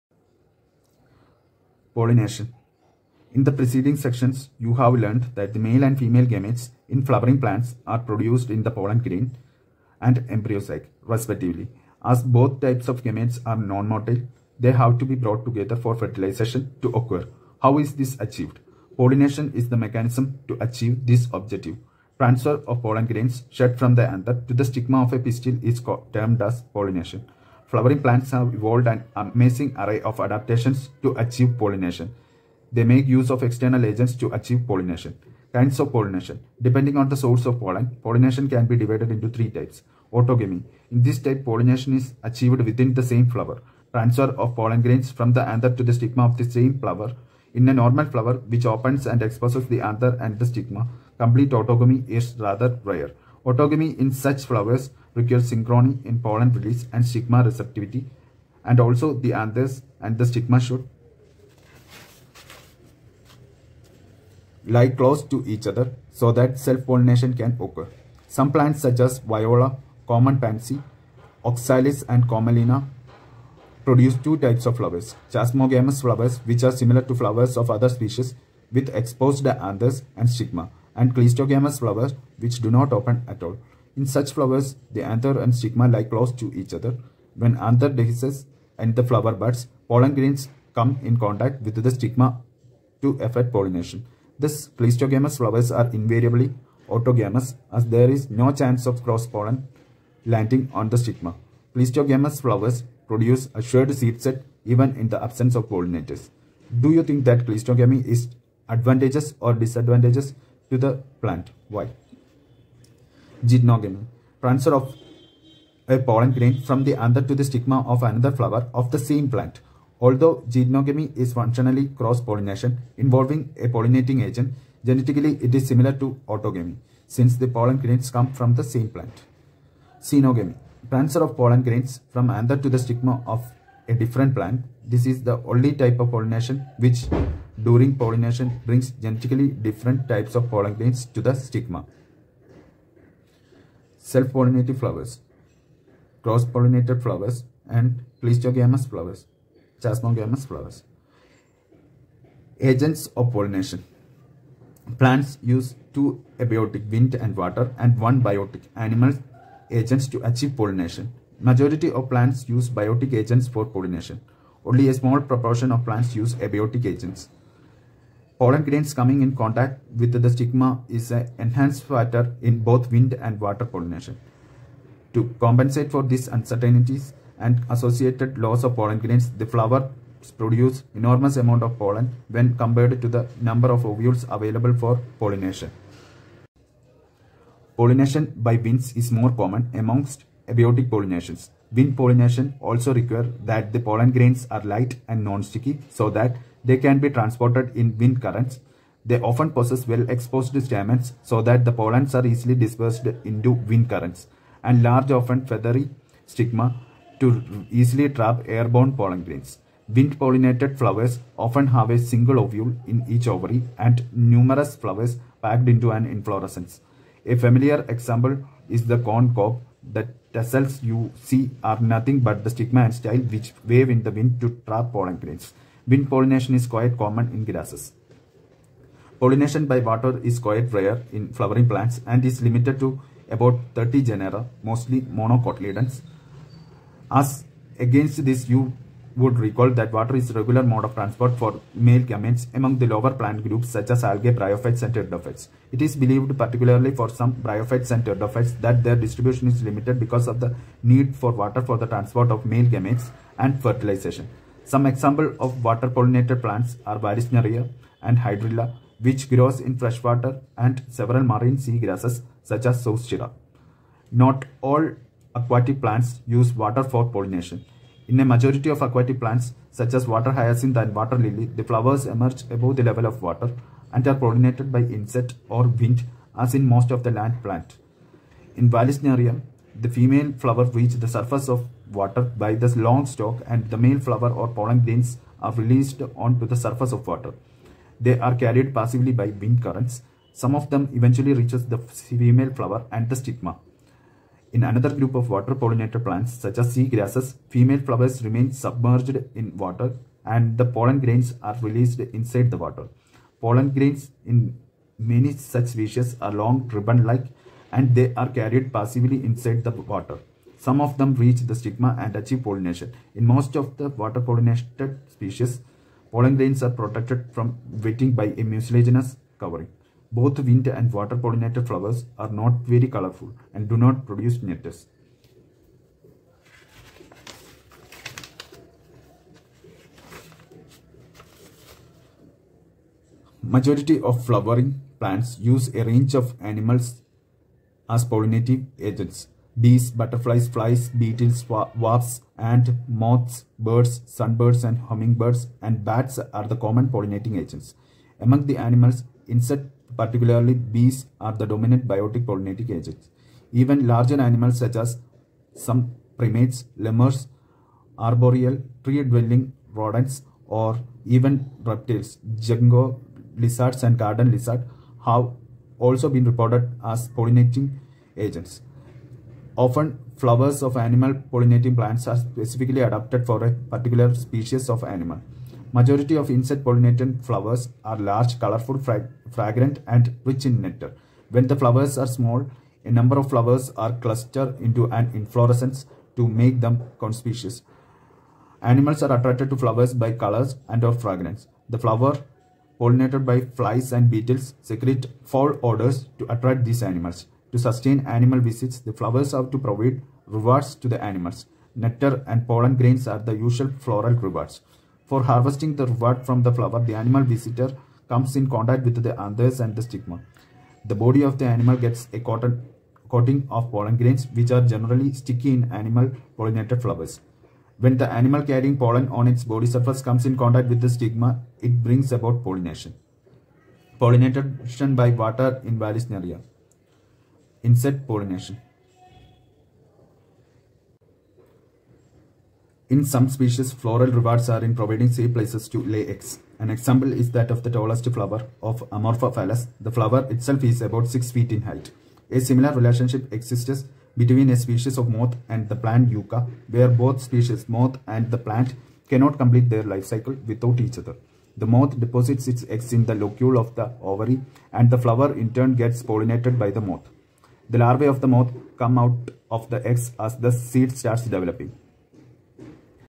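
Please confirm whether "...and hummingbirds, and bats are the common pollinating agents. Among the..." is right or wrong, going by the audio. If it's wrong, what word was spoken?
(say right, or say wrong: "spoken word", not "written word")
right.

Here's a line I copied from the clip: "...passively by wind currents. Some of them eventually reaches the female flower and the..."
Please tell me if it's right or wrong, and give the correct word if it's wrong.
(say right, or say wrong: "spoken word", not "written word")
right.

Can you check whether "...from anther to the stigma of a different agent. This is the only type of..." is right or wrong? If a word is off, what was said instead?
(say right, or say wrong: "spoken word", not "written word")
wrong: "plant", not "agent".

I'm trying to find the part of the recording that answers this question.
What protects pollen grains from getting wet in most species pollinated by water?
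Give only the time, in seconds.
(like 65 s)
318 s.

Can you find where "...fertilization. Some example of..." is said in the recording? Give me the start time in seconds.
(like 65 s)
253 s.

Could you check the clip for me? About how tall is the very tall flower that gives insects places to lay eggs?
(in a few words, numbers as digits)
6 feet.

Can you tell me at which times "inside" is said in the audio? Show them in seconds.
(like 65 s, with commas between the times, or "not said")
301 s, 309 s.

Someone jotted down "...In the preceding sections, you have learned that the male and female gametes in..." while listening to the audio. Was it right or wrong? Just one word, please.
right.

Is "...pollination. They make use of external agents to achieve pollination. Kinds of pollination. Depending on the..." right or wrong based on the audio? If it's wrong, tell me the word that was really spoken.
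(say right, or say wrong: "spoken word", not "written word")
right.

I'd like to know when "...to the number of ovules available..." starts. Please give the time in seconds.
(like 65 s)
183 s.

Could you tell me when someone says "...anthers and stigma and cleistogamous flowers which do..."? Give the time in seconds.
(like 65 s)
79 s.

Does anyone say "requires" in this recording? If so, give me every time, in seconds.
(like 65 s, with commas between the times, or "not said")
55 s, 192 s.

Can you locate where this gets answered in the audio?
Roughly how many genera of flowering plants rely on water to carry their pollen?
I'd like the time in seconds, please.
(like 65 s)
233 s.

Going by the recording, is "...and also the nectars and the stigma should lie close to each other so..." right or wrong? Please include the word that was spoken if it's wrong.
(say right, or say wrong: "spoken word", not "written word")
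wrong: "anthers", not "nectars".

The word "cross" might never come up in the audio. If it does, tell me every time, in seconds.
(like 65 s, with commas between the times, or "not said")
99 s, 121 s, 146 s.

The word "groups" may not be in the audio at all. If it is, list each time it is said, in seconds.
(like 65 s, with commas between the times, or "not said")
243 s, 294 s.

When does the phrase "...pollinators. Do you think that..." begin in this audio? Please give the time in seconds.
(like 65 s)
105 s.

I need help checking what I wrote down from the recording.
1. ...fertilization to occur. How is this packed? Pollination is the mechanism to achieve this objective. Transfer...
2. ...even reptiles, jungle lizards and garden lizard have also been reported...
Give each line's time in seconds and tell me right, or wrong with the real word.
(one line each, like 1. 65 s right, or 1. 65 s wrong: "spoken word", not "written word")
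1. 15 s wrong: "achieved", not "packed"
2. 361 s right.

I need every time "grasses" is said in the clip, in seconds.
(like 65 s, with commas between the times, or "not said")
227 s, 261 s, 296 s.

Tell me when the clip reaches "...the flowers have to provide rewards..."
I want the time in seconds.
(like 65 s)
398 s.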